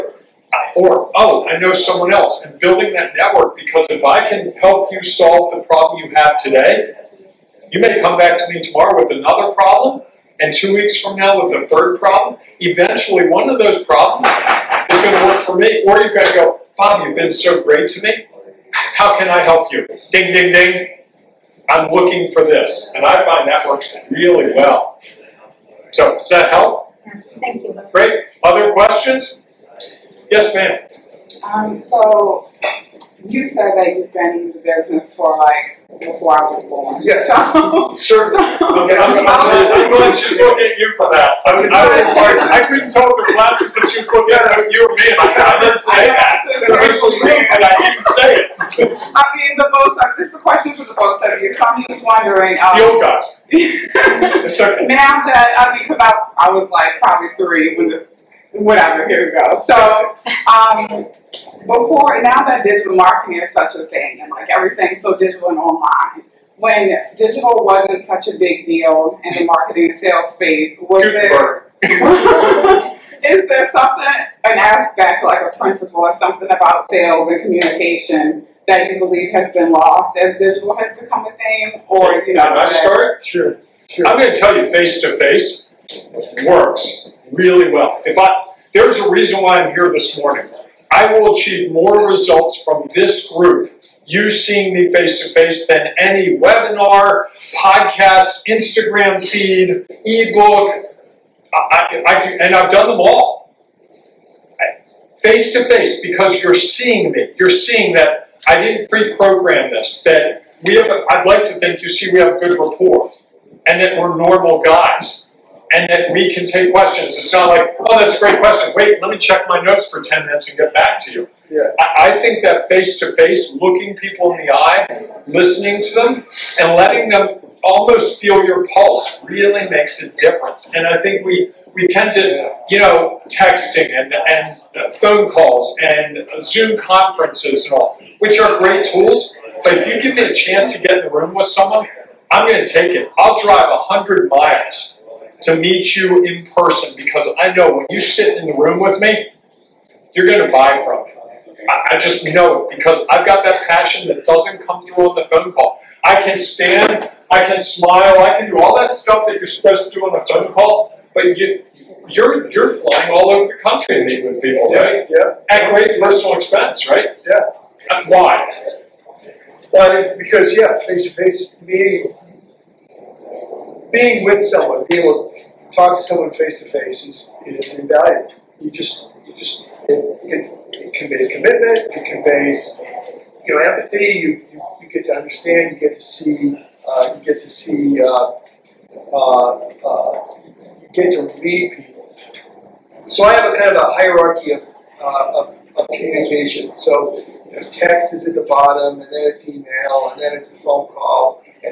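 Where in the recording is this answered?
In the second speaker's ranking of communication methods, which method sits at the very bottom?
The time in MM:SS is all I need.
03:17.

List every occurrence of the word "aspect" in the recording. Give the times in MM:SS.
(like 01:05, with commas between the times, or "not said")
01:14.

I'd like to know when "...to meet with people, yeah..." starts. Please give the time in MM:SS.
02:43.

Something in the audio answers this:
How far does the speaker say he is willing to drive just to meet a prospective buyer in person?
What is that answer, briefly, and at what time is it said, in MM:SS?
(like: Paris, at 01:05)
100 miles, at 02:23.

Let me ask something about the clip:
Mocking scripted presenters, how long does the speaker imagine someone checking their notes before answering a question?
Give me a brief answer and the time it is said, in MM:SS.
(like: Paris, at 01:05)
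10 minutes, at 02:00.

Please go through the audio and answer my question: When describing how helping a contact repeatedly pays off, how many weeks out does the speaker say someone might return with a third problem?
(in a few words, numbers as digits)
2.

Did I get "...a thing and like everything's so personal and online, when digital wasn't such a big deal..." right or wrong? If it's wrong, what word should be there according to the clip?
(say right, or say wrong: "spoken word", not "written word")
wrong: "digital", not "personal".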